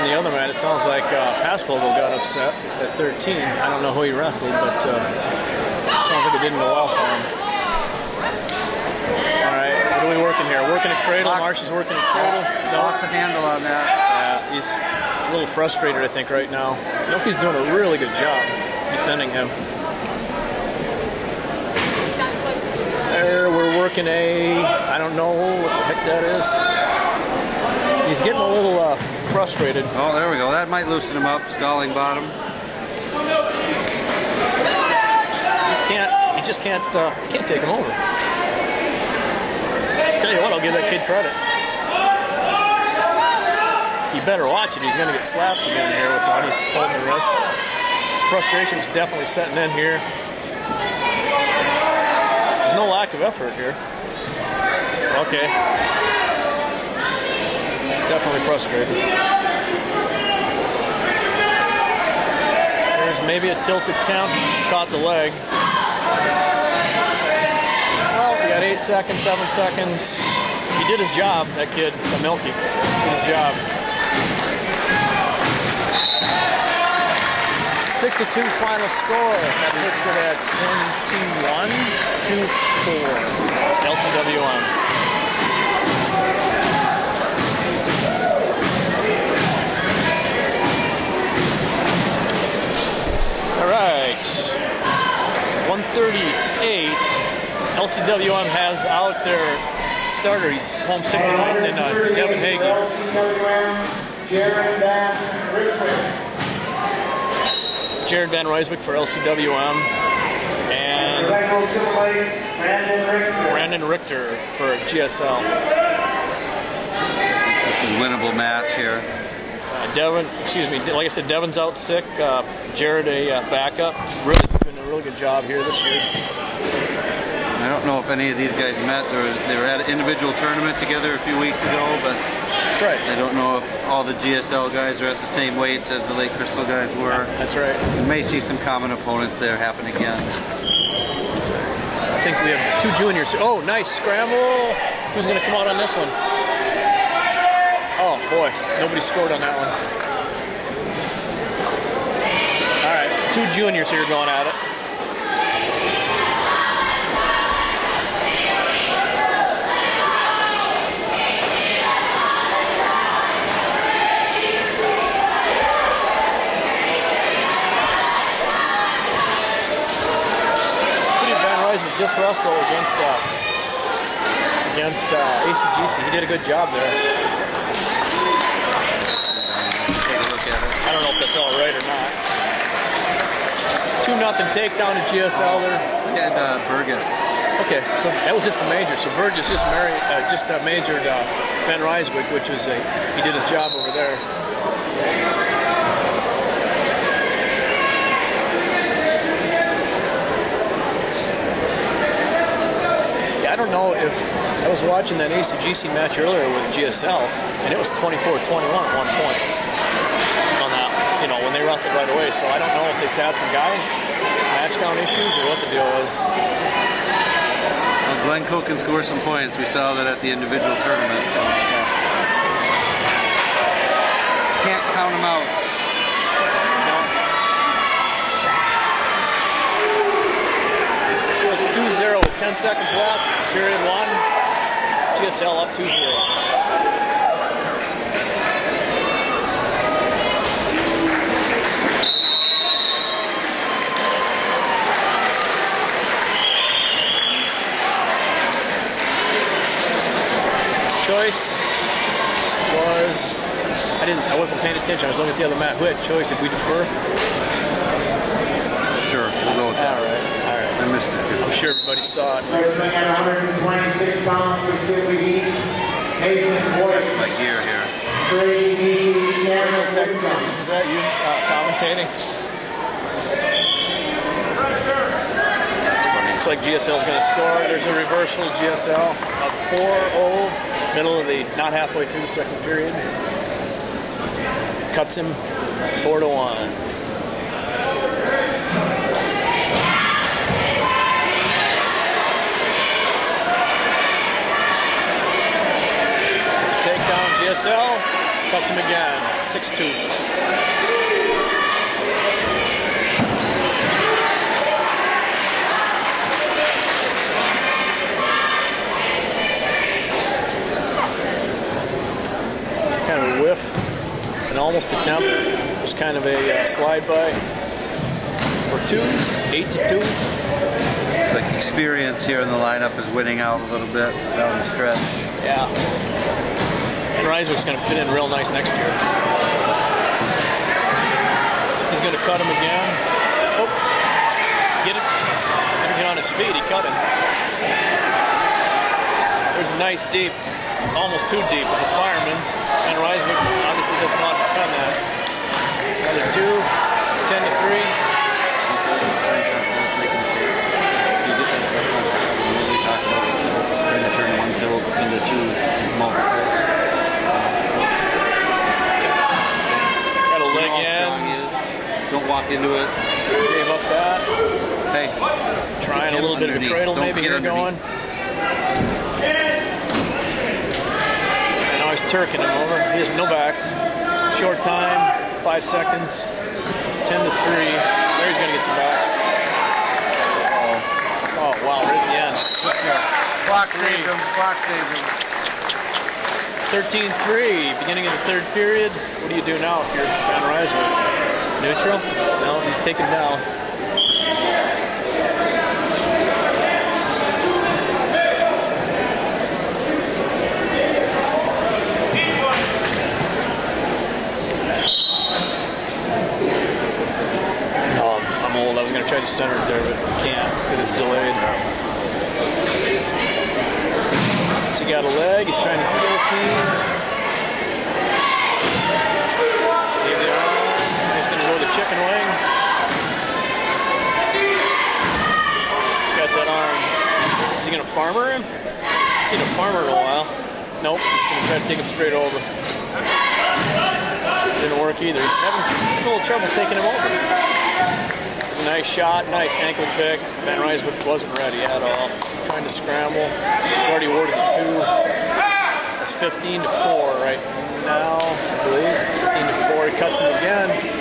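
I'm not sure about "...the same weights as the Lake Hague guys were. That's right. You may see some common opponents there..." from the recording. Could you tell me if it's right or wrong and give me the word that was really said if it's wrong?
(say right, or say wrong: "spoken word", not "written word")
wrong: "Crystal", not "Hague".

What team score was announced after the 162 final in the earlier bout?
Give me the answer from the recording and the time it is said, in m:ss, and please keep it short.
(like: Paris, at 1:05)
21-24, at 1:21.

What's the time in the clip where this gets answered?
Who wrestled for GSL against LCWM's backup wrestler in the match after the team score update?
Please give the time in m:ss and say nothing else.
1:53.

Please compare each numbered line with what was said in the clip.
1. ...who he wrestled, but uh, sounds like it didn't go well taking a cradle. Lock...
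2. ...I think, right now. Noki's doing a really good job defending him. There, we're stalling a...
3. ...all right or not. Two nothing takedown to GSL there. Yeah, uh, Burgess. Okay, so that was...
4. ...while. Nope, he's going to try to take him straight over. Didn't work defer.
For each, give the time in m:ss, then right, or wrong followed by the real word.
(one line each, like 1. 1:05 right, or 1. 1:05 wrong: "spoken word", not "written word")
1. 0:03 wrong: "working", not "taking"
2. 0:16 wrong: "working", not "stalling"
3. 3:01 right
4. 7:09 wrong: "either", not "defer".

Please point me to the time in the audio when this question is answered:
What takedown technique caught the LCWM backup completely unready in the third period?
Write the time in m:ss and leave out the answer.
7:19.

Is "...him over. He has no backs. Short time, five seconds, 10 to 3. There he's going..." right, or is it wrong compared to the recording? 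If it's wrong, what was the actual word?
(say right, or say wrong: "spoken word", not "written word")
right.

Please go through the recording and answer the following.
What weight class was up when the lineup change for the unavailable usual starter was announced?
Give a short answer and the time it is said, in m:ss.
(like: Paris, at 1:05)
138, at 1:35.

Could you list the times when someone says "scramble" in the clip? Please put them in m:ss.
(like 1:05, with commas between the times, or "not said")
2:23, 7:22.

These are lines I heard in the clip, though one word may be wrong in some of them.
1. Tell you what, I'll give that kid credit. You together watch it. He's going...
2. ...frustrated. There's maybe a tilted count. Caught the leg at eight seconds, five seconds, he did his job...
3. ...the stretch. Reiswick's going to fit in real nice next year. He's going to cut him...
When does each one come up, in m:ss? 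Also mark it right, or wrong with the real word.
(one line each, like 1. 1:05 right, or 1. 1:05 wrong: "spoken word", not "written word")
1. 0:40 wrong: "better", not "together"
2. 0:58 wrong: "seven", not "five"
3. 5:24 right.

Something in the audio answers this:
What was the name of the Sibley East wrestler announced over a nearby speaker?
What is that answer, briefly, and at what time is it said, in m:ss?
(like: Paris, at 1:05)
Mason Boyd, at 4:26.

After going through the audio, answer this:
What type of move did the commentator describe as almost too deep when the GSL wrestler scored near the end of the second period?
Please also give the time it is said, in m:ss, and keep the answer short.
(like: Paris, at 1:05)
fireman's, at 5:42.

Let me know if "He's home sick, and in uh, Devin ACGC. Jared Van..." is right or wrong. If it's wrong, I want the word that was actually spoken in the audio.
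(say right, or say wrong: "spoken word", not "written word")
wrong: "Hague", not "ACGC".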